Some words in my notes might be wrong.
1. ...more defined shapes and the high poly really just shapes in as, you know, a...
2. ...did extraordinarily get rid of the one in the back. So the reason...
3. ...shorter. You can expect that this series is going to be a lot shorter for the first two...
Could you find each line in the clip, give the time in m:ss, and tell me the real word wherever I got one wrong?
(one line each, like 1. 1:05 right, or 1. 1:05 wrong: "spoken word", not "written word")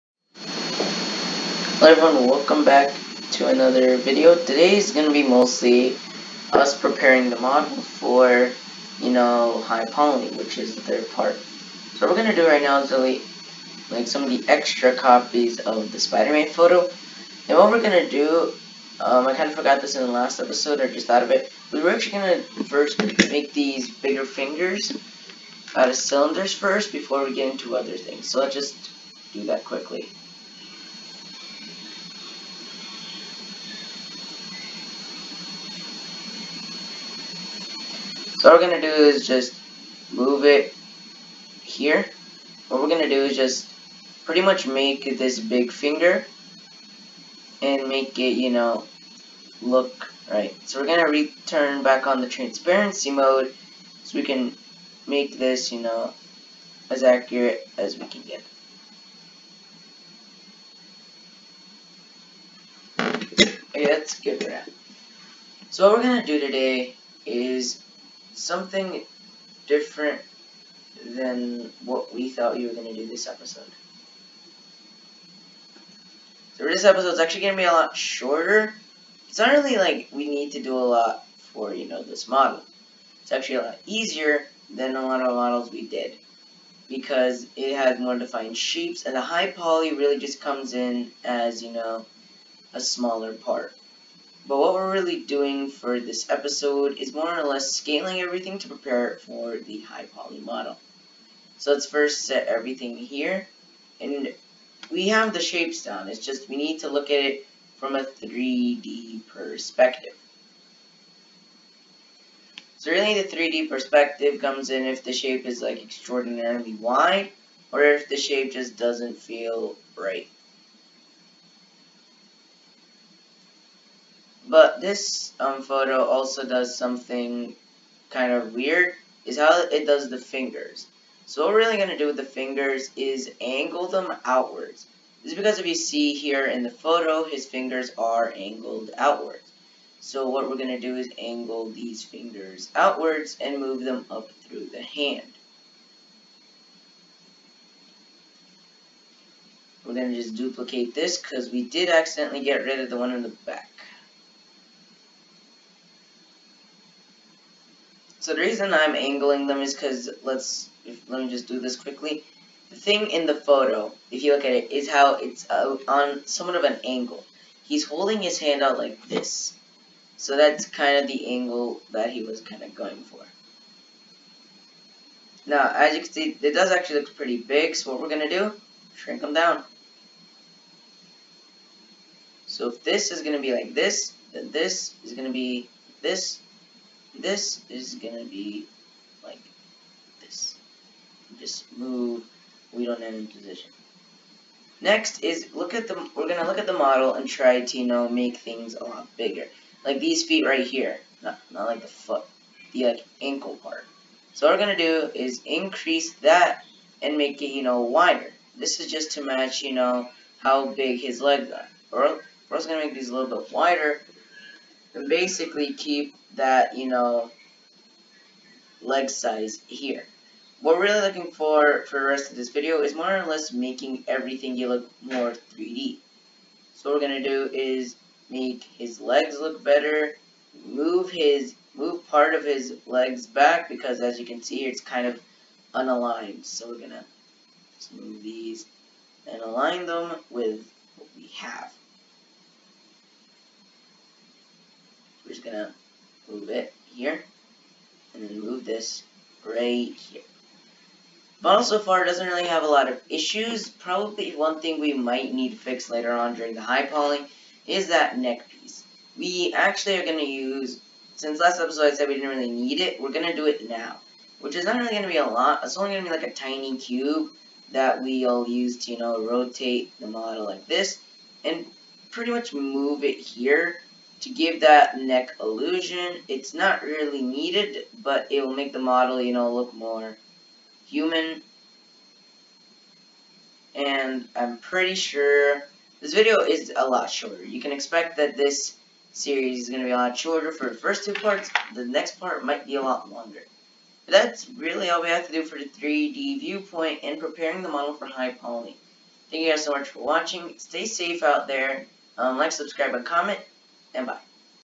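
1. 1:27 wrong: "comes", not "shapes"
2. 2:31 wrong: "accidentally", not "extraordinarily"
3. 4:47 right.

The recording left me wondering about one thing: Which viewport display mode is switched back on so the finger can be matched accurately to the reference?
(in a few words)
Transparency mode.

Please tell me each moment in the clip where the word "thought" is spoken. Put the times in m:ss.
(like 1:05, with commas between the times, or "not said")
0:21, 1:12.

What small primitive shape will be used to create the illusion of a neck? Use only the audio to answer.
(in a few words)
Cube.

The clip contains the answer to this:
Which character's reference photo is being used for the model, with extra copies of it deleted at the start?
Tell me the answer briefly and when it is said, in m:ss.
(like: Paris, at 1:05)
Spider-Man, at 0:15.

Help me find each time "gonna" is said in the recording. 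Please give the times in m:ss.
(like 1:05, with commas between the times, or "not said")
3:07, 3:16, 3:24, 3:32, 4:05.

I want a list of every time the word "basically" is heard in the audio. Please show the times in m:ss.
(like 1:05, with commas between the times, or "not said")
3:35.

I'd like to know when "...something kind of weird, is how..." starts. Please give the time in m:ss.
2:06.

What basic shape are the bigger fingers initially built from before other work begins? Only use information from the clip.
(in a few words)
Cylinders.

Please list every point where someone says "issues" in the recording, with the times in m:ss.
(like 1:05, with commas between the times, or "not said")
4:13.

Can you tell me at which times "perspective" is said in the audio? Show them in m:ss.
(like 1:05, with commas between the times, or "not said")
1:49, 1:53.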